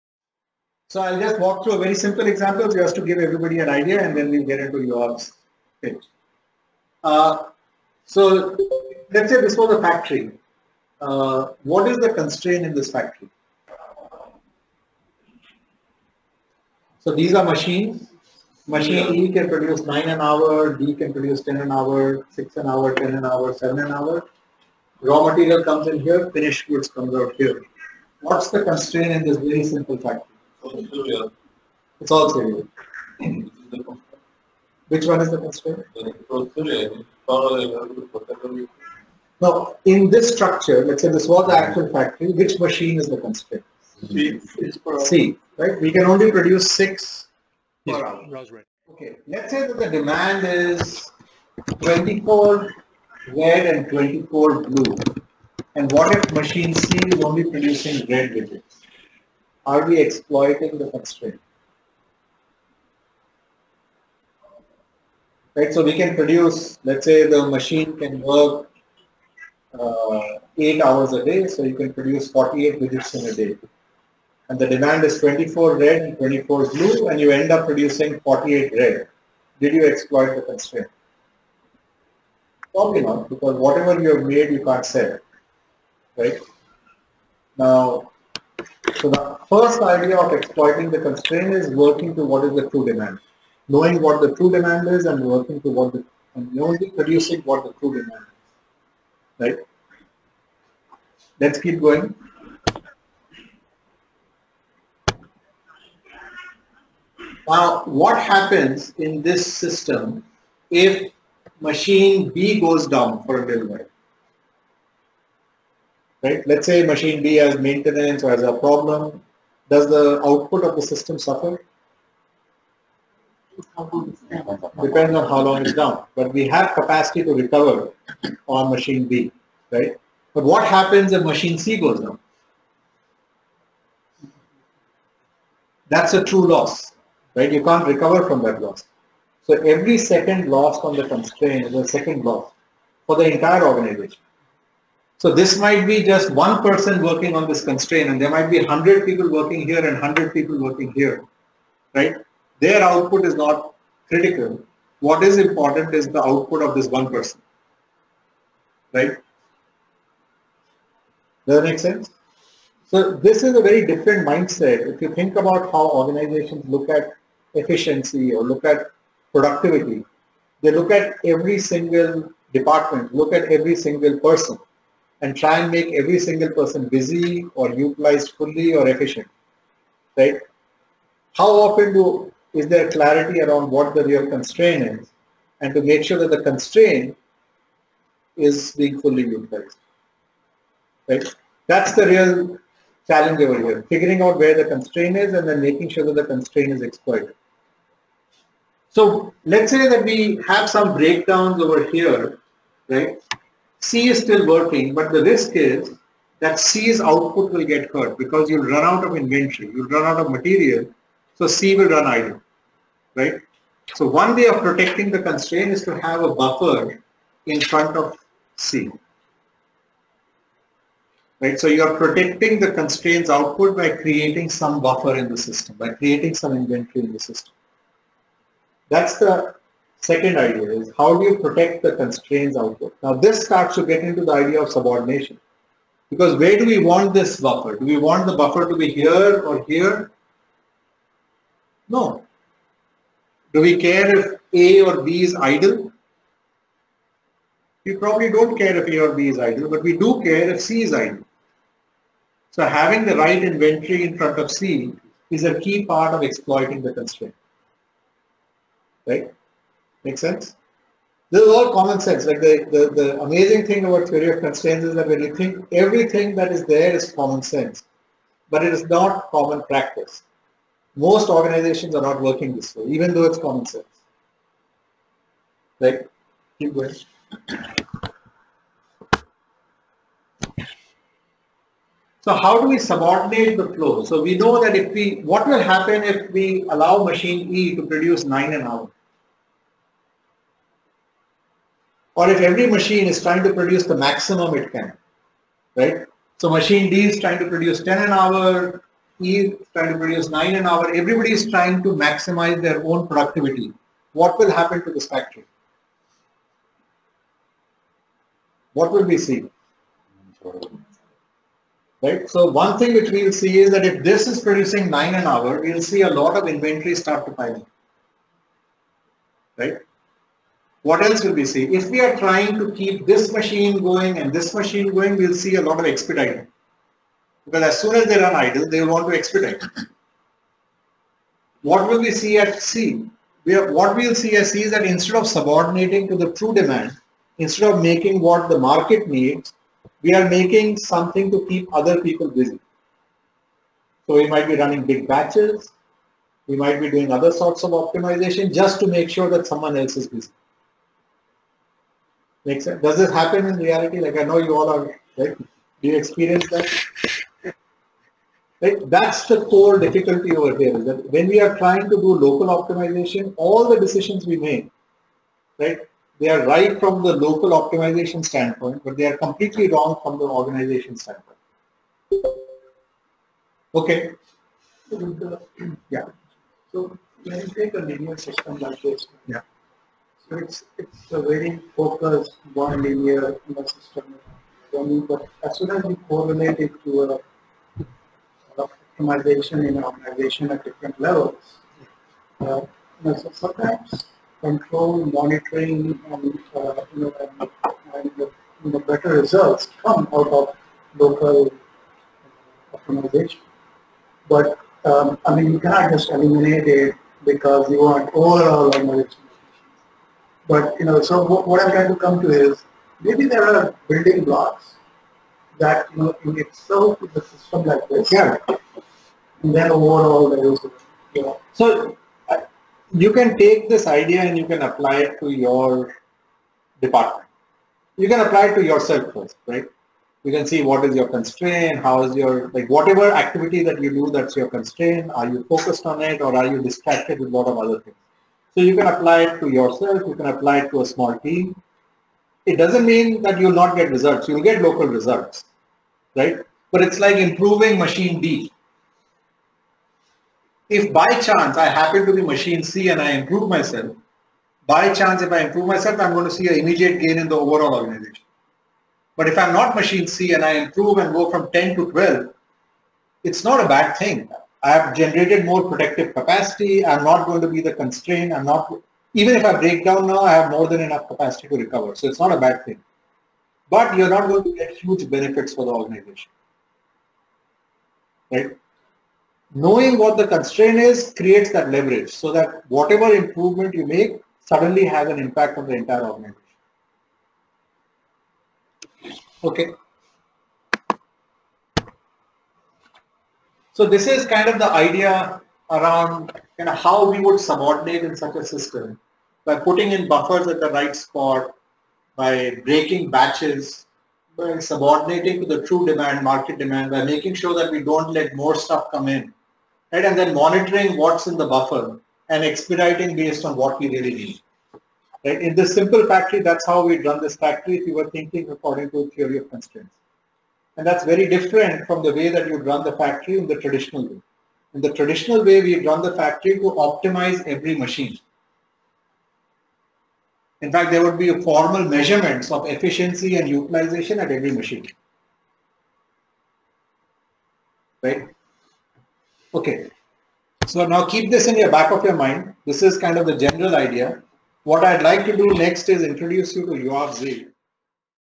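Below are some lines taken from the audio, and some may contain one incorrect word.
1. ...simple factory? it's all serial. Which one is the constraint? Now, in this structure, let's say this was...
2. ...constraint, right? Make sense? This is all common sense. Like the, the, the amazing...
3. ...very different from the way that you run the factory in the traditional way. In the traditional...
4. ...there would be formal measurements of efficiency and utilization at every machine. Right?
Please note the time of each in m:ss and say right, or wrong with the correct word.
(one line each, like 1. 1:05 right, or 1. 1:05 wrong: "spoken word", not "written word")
1. 0:29 right
2. 4:16 right
3. 8:41 right
4. 8:50 right.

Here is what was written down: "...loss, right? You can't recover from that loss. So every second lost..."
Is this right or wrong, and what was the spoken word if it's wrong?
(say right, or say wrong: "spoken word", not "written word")
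right.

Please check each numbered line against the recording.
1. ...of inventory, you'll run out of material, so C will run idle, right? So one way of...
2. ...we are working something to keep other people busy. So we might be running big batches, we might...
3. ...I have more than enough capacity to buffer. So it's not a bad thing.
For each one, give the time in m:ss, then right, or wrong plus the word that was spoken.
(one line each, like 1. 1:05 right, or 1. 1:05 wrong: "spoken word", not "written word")
1. 3:29 right
2. 5:40 wrong: "making", not "working"
3. 7:50 wrong: "recover", not "buffer".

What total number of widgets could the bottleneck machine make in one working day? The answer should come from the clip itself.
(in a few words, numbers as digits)
48 widgets.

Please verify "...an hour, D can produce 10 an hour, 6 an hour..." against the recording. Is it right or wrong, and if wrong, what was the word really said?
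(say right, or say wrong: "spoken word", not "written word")
right.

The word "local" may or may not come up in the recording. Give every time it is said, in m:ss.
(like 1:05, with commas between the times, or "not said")
6:01, 6:07, 6:40, 7:24.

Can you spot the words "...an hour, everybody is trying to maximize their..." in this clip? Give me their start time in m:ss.
5:00.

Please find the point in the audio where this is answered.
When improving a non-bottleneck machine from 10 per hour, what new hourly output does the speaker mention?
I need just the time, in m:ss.
7:41.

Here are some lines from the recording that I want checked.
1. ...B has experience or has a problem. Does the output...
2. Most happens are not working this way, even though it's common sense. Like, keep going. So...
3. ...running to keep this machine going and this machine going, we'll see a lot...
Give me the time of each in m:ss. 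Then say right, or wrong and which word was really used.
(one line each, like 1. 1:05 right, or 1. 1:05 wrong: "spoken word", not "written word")
1. 1:57 wrong: "maintenance", not "experience"
2. 4:30 wrong: "organizations", not "happens"
3. 5:22 wrong: "trying", not "running".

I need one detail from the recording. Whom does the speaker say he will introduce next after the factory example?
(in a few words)
Yoav Zee.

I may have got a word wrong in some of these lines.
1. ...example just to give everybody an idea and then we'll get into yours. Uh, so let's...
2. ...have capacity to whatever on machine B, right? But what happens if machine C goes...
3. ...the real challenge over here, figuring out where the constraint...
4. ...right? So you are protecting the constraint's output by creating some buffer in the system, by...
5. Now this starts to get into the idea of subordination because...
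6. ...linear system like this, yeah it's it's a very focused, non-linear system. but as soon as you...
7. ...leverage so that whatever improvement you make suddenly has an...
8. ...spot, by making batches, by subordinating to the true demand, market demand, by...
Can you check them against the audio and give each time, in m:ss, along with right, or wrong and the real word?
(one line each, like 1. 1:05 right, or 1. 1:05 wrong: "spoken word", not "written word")
1. 0:02 right
2. 2:06 wrong: "recover", not "whatever"
3. 3:11 right
4. 3:41 right
5. 3:53 right
6. 6:17 right
7. 8:01 right
8. 8:20 wrong: "breaking", not "making".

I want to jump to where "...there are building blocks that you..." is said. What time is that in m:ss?
6:53.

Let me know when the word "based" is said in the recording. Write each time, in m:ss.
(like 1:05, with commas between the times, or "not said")
8:33.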